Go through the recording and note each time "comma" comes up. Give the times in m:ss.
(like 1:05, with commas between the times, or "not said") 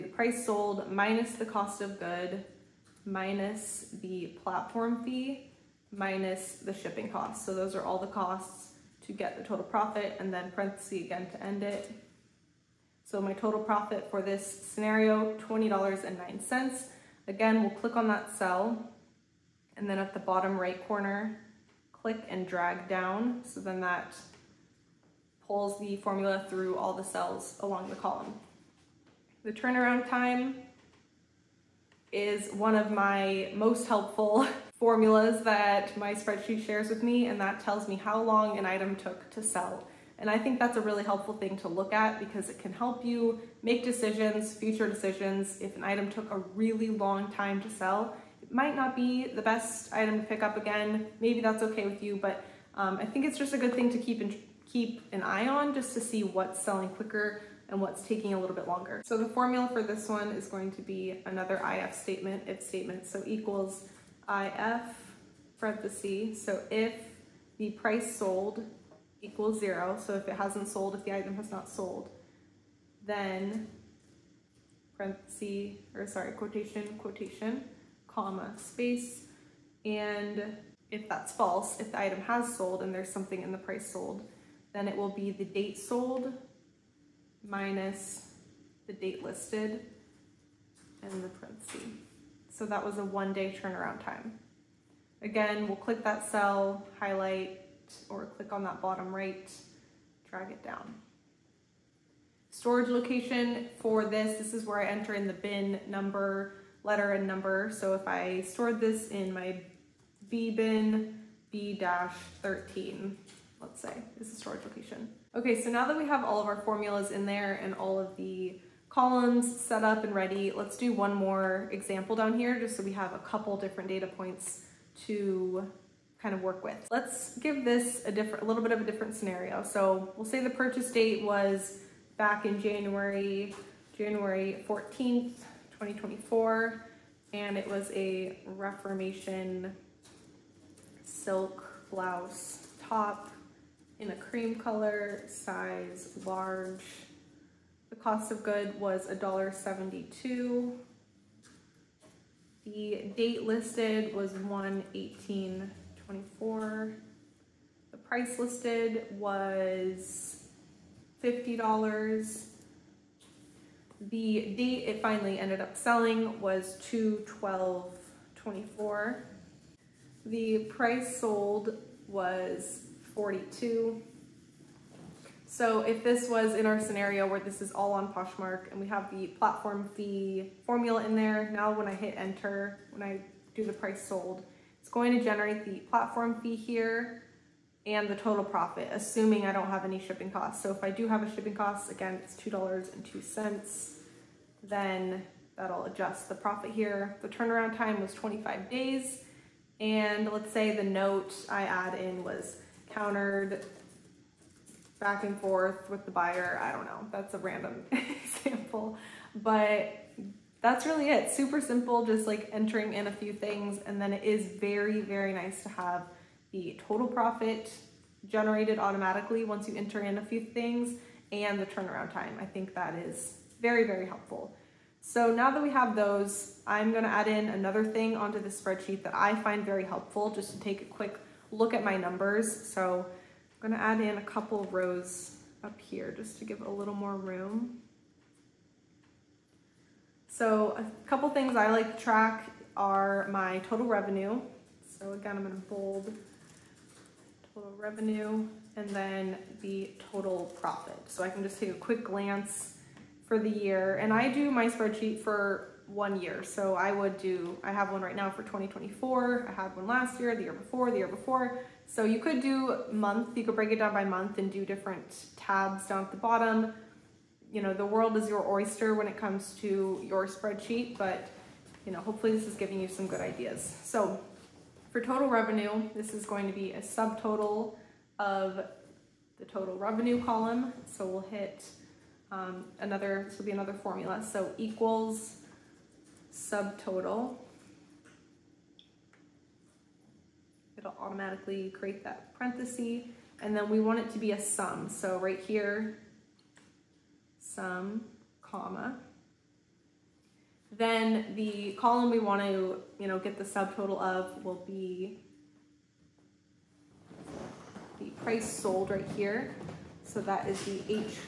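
1:18, 4:58.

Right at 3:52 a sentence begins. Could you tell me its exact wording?
So I'm gonna add in a couple rows up here just to give a little more room.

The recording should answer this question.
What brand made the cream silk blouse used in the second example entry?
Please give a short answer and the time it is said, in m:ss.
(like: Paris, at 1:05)
Reformation, at 2:18.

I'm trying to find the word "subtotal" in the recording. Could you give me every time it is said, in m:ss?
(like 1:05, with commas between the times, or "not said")
4:36, 4:46, 5:03.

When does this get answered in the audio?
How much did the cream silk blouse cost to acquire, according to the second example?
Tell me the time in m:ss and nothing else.
2:29.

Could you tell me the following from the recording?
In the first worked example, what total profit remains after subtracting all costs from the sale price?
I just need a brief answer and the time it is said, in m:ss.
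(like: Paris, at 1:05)
$20.09, at 0:15.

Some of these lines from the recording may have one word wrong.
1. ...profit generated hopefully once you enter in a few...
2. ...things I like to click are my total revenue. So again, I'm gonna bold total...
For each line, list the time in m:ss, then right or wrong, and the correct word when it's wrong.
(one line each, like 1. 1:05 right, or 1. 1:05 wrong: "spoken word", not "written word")
1. 3:37 wrong: "automatically", not "hopefully"
2. 4:01 wrong: "track", not "click".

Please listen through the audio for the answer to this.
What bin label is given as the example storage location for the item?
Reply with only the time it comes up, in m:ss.
1:51.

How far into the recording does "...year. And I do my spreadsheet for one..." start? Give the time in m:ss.
4:13.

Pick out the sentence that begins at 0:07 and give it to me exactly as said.
So those are all the costs to get the total profit and then parenthesis again to end it.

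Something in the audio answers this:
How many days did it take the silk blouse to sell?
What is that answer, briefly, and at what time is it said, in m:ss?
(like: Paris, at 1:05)
25 days, at 3:18.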